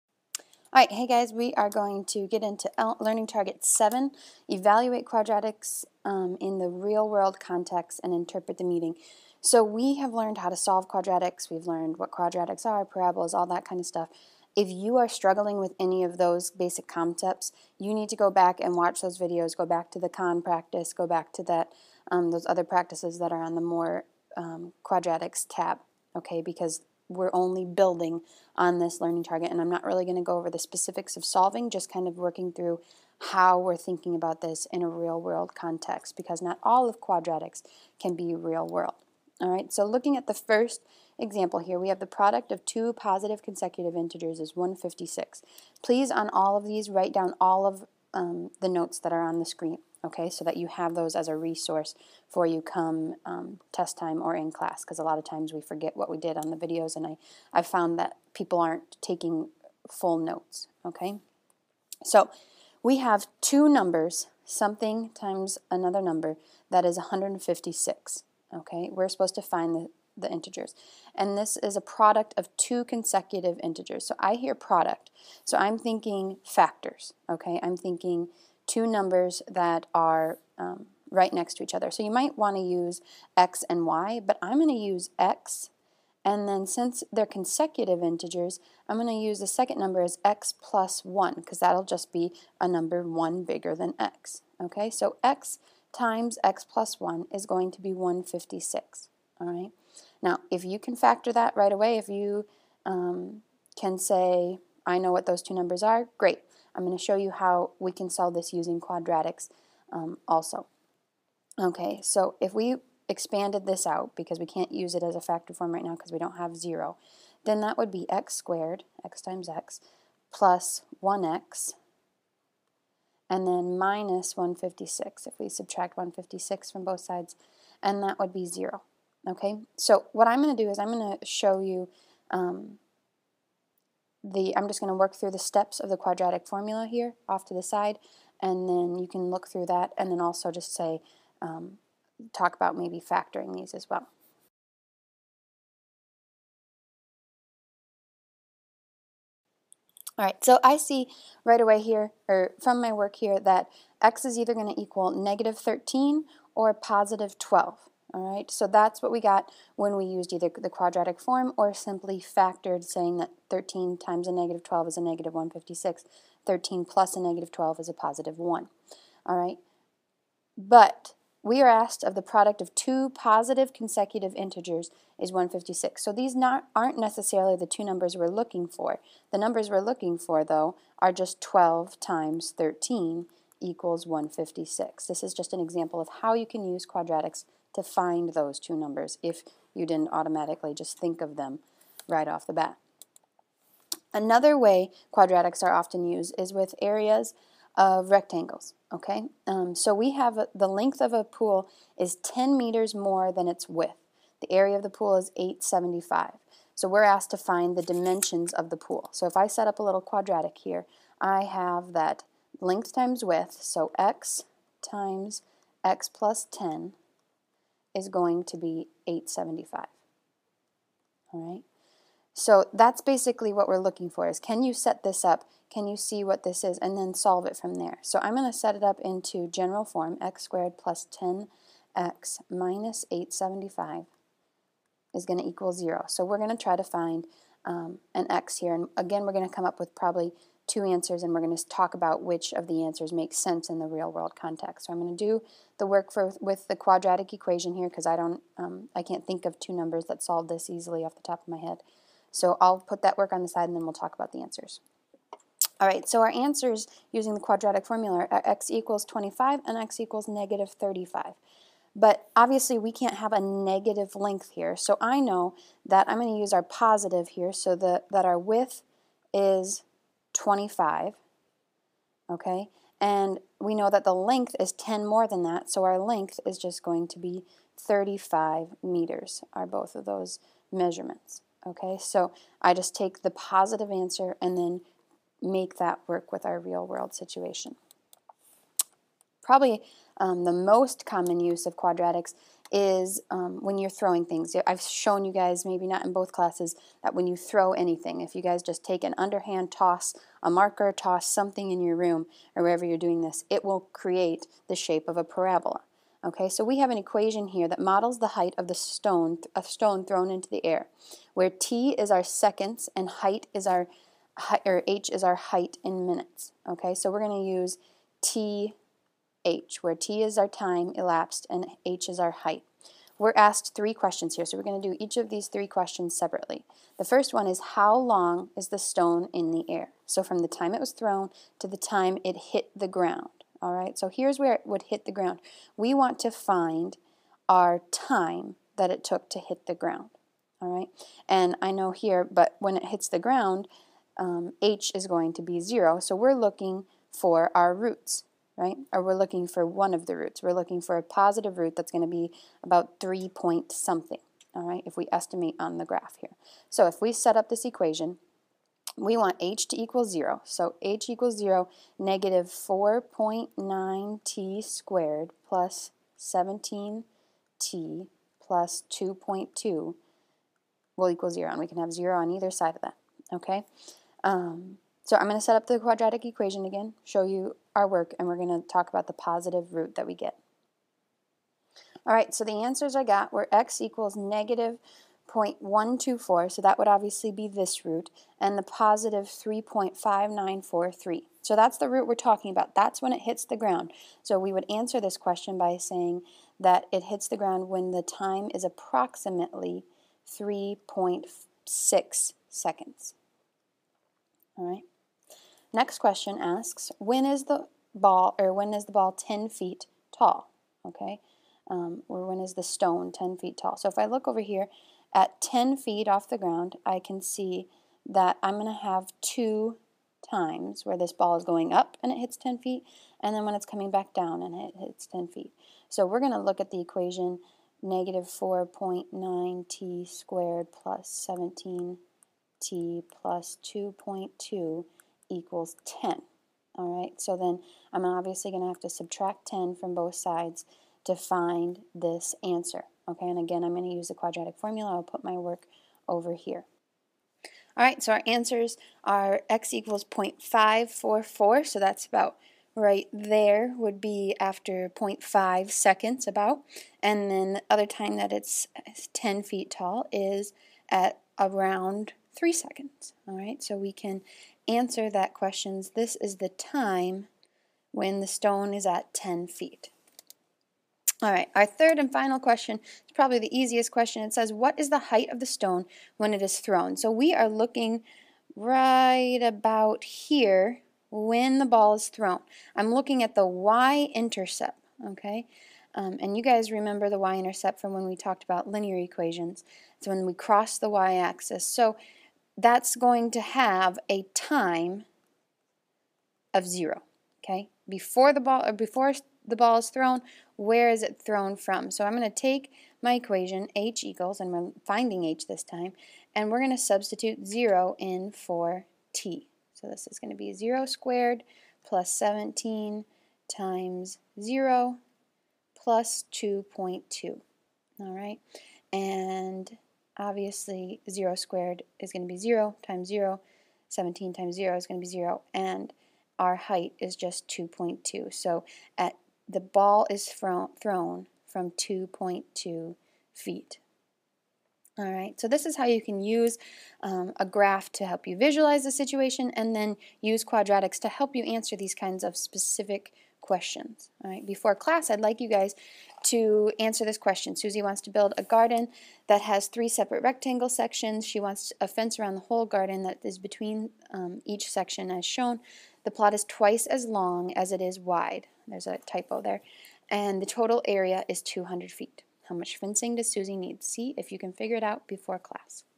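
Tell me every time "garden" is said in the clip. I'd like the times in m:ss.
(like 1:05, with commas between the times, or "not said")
9:08, 9:12.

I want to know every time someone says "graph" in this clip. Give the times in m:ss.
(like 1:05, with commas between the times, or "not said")
5:55, 8:57.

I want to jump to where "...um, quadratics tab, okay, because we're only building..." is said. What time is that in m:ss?
0:24.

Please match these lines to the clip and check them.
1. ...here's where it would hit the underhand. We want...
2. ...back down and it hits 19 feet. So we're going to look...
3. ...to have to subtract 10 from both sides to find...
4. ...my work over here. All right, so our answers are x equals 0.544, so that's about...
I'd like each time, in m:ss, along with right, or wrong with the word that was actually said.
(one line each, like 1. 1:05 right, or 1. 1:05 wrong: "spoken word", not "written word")
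1. 5:34 wrong: "ground", not "underhand"
2. 7:03 wrong: "10", not "19"
3. 7:18 right
4. 7:25 right.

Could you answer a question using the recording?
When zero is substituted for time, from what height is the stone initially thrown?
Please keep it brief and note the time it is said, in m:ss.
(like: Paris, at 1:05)
2.2 feet, at 8:51.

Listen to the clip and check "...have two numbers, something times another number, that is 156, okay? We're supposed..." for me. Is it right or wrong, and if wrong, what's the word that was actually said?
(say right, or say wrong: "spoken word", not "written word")
right.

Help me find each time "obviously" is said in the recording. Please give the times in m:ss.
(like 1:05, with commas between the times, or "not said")
4:22, 6:26, 7:18, 8:40.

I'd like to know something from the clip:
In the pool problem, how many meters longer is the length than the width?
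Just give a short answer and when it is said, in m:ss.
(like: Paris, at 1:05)
10 meters, at 3:22.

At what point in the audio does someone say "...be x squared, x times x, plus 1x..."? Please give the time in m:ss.
1:57.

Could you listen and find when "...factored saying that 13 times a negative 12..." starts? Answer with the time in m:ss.
2:42.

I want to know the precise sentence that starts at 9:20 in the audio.
And the total area is 200 feet.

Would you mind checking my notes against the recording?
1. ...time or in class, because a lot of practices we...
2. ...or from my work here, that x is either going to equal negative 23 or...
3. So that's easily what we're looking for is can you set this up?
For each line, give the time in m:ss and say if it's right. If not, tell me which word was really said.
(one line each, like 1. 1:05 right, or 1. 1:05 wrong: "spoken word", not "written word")
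1. 0:53 wrong: "times", not "practices"
2. 2:32 wrong: "13", not "23"
3. 3:42 wrong: "basically", not "easily".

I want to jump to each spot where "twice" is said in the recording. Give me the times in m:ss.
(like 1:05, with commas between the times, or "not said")
9:16.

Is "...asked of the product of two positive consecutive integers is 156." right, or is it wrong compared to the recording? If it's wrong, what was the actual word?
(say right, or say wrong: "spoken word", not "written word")
right.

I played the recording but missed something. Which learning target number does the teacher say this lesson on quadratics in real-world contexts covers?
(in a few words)
7.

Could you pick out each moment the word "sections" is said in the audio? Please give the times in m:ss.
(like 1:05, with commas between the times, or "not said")
9:10, 9:14.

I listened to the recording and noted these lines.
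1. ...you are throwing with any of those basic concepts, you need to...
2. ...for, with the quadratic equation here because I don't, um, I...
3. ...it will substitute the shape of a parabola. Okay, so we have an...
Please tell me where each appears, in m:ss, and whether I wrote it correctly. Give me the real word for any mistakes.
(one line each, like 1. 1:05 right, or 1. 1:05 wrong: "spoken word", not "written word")
1. 0:14 wrong: "struggling", not "throwing"
2. 4:06 right
3. 5:03 wrong: "create", not "substitute".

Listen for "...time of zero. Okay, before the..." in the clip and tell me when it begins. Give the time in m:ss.
8:14.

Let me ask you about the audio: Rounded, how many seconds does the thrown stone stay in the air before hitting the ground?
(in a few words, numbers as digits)
3.6 seconds.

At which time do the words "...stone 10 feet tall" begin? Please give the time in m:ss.
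6:52.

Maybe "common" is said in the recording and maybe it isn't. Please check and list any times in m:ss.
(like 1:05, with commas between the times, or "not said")
4:51.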